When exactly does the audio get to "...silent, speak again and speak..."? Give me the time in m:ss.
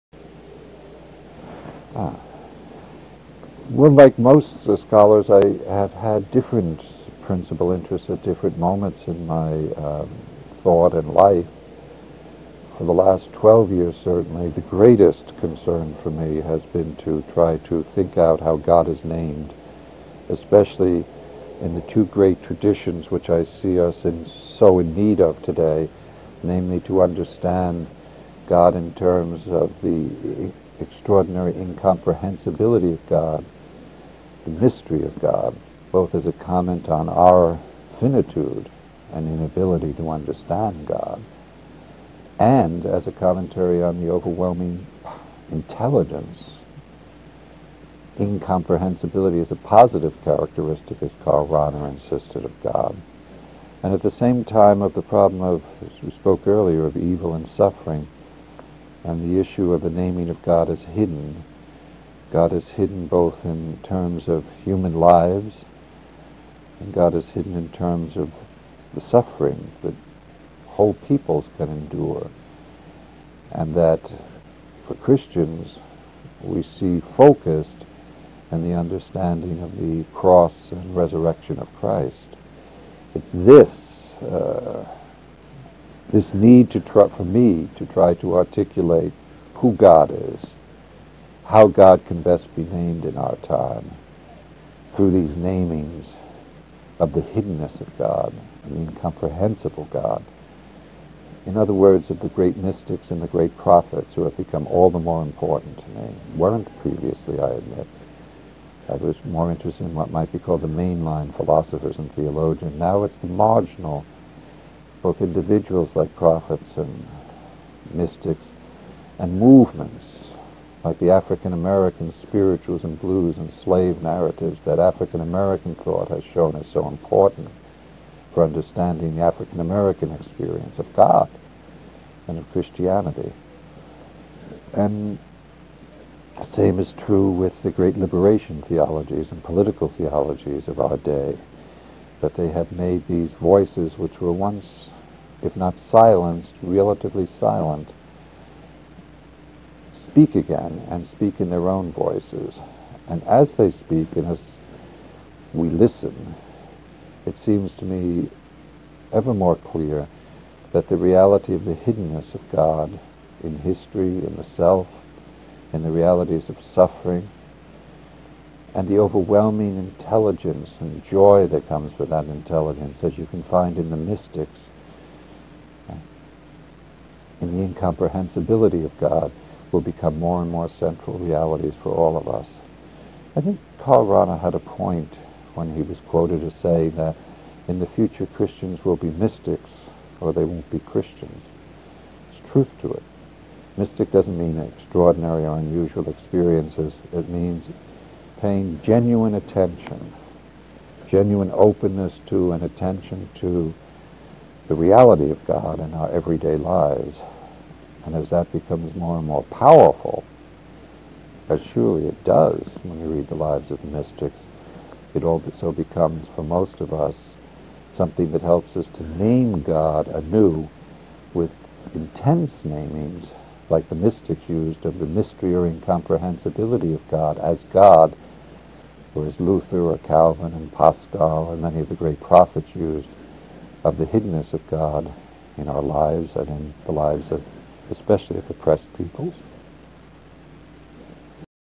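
2:27.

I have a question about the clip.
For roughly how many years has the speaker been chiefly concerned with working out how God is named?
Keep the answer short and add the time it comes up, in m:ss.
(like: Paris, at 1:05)
12, at 0:13.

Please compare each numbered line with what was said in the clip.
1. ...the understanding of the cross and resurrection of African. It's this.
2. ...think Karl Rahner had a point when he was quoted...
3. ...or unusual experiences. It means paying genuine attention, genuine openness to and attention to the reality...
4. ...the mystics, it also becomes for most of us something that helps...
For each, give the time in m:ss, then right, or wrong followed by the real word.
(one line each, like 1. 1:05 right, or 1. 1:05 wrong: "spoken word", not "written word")
1. 1:18 wrong: "Christ", not "African"
2. 3:03 right
3. 3:15 right
4. 3:33 right.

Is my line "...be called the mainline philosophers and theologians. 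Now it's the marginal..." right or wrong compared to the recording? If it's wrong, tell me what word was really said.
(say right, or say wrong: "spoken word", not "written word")
right.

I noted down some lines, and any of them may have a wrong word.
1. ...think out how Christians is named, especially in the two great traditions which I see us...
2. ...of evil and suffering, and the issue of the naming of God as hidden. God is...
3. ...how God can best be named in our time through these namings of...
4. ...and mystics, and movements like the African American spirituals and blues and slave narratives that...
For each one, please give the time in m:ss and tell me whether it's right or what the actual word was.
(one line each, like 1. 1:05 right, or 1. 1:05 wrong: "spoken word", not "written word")
1. 0:17 wrong: "God", not "Christians"
2. 0:56 right
3. 1:31 right
4. 1:56 right.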